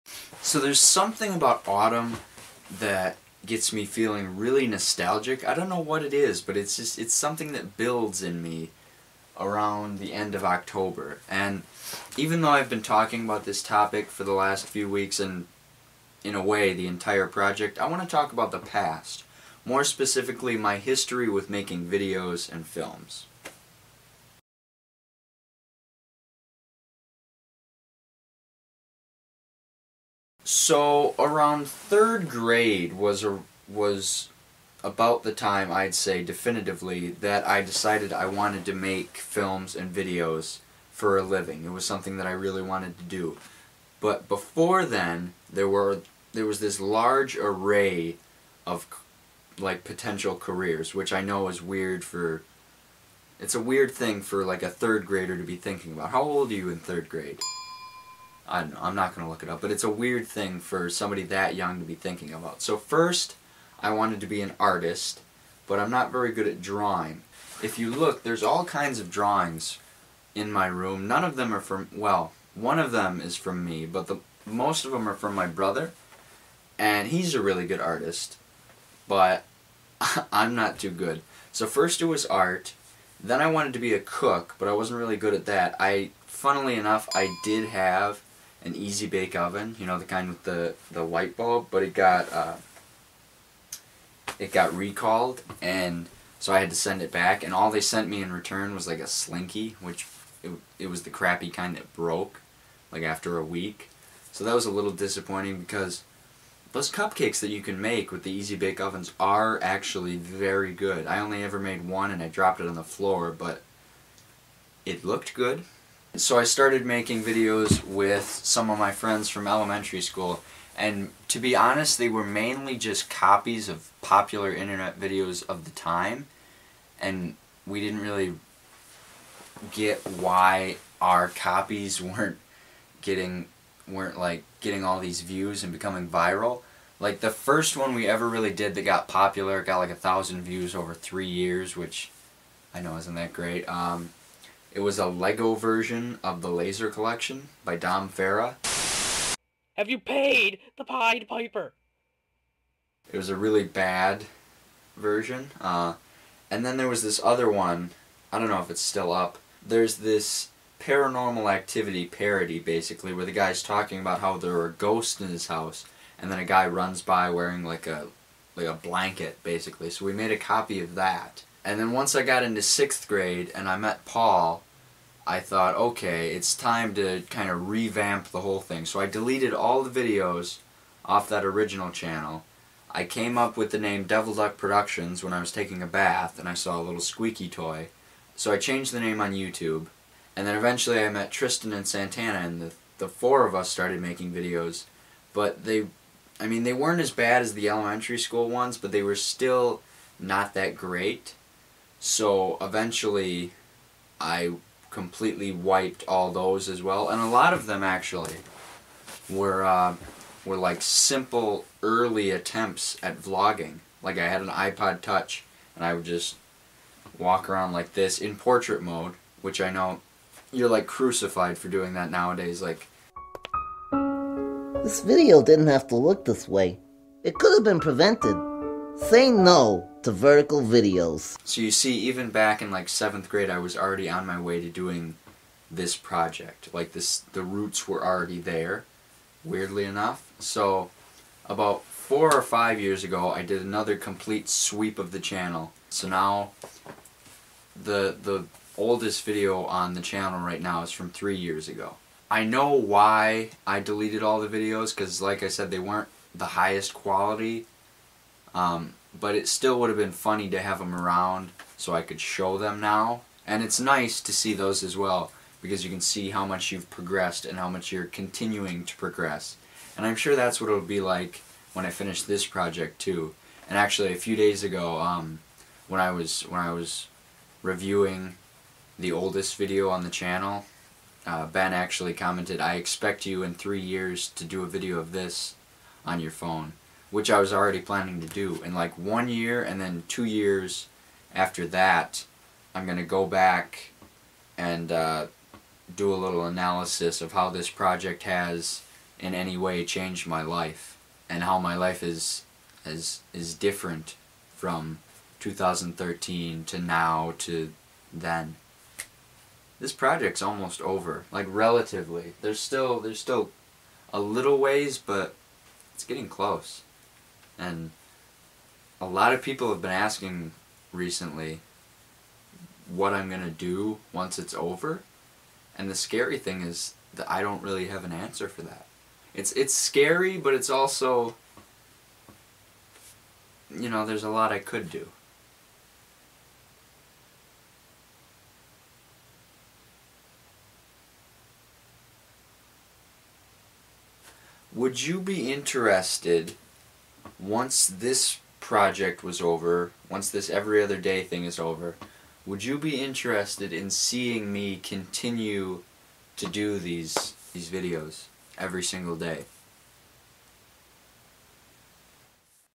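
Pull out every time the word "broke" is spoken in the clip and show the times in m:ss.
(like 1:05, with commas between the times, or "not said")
1:41.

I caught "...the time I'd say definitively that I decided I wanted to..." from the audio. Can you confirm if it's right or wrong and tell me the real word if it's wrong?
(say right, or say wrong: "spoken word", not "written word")
right.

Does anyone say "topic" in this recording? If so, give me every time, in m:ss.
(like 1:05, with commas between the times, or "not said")
0:13.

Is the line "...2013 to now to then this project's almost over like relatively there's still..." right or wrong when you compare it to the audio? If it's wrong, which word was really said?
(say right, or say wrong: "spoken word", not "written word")
right.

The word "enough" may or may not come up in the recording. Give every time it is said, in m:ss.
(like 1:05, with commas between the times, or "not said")
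1:26, 3:59.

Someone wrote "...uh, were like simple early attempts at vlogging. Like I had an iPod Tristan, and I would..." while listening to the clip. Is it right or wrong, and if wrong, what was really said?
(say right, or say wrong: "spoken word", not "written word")
wrong: "Touch", not "Tristan".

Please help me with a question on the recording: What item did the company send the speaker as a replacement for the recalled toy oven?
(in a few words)
a slinky.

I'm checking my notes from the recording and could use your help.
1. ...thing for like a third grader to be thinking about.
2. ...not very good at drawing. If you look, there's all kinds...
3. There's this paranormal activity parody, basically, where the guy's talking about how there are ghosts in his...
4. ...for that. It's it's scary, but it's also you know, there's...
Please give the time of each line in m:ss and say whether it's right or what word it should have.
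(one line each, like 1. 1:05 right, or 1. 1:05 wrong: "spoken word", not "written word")
1. 0:53 right
2. 1:05 right
3. 2:39 right
4. 5:28 right.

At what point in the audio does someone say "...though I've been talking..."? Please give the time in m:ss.
0:12.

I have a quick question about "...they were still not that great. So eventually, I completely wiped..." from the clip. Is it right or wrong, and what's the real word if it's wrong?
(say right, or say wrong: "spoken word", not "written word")
right.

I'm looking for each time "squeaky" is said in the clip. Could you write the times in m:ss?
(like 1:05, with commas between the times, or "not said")
3:06.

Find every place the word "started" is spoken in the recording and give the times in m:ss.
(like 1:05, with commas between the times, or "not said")
1:56, 3:13.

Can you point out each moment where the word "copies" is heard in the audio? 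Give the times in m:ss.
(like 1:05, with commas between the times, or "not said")
2:03, 2:11.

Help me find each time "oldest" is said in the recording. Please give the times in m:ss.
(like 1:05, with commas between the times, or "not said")
4:08, 4:39.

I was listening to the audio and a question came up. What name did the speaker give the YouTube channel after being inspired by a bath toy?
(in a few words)
Devil Duck Productions.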